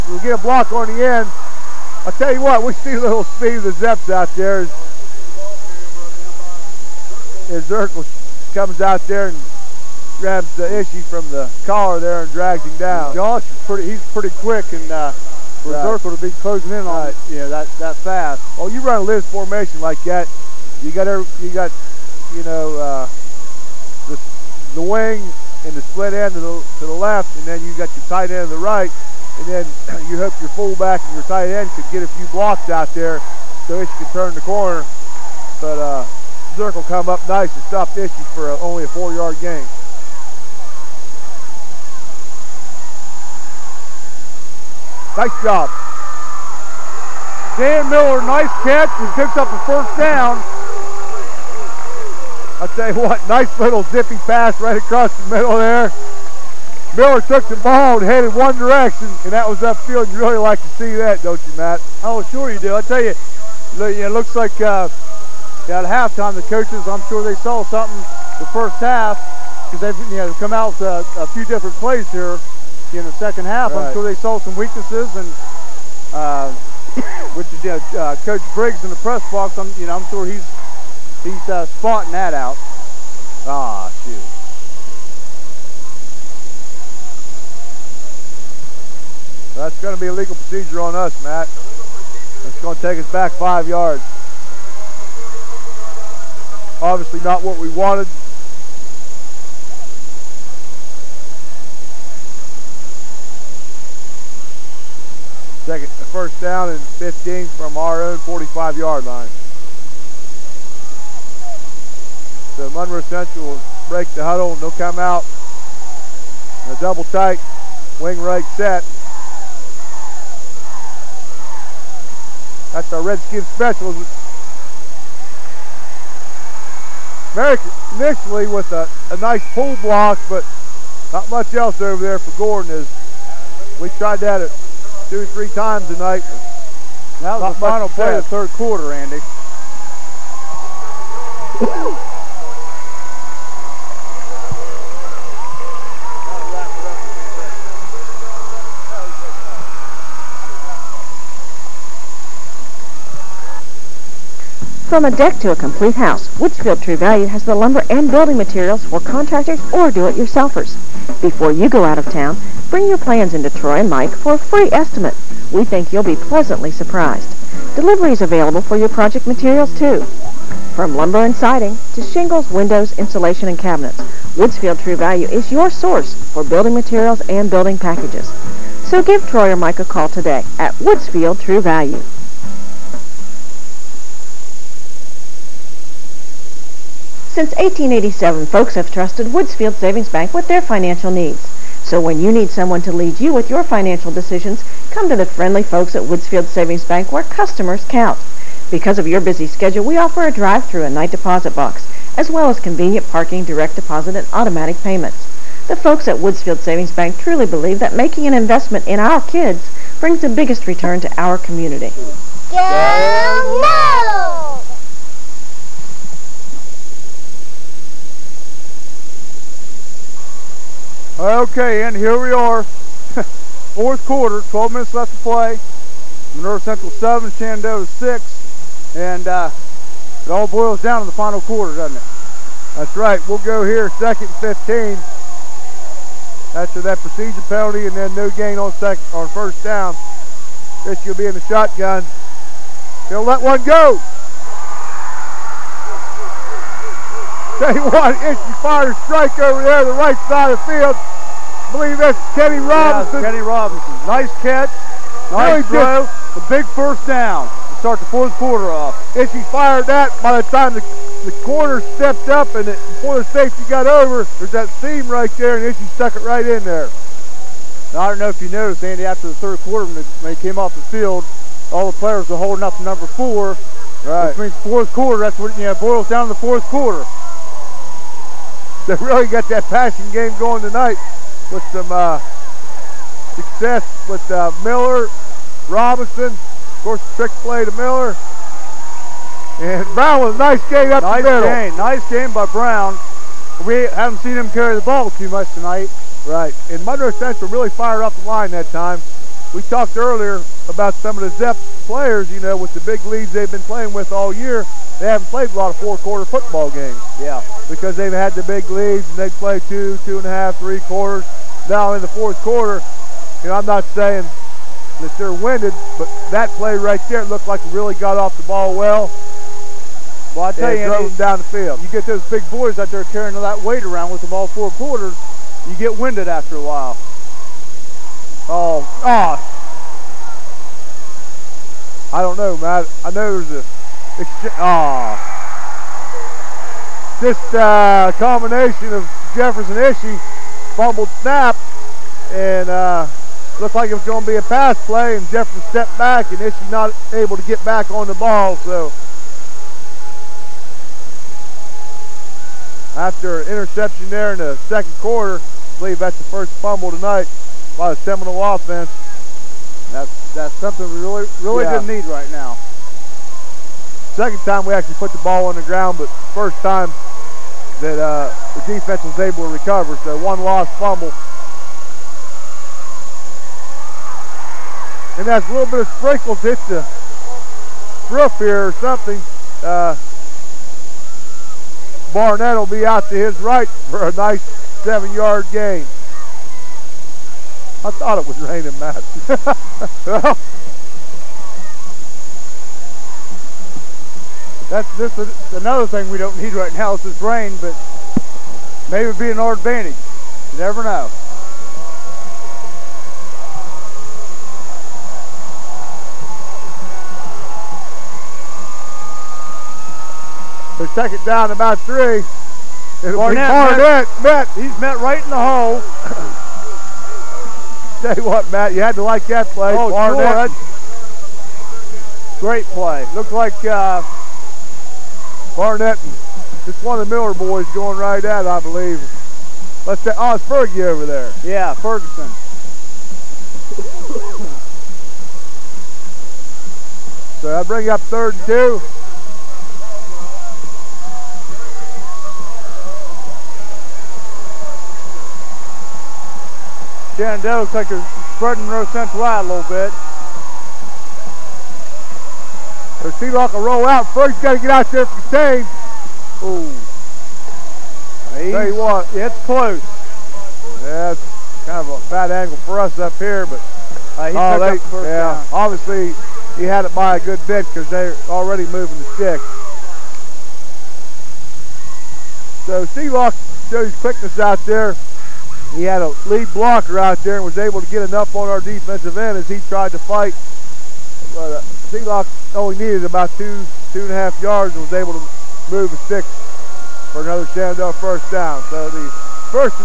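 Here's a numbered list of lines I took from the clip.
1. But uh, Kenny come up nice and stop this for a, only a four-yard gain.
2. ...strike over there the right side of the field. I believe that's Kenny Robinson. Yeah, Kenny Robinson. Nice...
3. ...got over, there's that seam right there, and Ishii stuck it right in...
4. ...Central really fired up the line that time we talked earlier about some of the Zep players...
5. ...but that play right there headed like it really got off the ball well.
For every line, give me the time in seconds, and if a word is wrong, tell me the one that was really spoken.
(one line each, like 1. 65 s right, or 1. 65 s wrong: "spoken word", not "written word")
1. 35 s wrong: "Zirkle", not "Kenny"
2. 249 s right
3. 263 s right
4. 297 s right
5. 315 s wrong: "looked", not "headed".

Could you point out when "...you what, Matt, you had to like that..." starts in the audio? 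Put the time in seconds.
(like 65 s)
418 s.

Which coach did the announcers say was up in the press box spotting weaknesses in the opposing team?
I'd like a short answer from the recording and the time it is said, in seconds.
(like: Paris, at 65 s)
Coach Briggs, at 78 s.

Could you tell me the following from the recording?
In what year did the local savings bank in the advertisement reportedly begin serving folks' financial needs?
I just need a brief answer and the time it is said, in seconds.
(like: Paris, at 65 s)
1887, at 187 s.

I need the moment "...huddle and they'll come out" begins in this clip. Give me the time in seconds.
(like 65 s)
114 s.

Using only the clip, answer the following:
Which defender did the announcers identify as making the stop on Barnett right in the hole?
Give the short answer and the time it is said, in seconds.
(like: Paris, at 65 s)
Ferguson, at 431 s.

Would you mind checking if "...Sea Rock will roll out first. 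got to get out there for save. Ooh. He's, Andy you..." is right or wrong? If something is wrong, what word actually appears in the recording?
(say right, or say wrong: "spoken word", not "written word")
wrong: "Tell", not "Andy".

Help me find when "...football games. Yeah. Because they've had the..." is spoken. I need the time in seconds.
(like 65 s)
306 s.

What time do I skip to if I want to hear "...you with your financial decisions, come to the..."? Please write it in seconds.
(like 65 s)
193 s.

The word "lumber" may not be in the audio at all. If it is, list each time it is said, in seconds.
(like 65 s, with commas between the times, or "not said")
157 s, 170 s.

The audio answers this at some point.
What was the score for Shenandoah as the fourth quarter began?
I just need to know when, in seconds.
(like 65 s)
227 s.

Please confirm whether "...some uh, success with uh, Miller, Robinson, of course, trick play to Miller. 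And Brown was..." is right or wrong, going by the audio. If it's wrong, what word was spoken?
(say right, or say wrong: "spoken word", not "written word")
right.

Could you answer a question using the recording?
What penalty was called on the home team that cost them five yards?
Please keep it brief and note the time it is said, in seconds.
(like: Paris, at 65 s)
legal procedure, at 90 s.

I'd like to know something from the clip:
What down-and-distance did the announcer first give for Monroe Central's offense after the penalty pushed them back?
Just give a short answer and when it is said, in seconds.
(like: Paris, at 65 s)
first down and 15, at 105 s.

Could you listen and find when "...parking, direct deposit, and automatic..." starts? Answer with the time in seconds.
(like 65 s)
203 s.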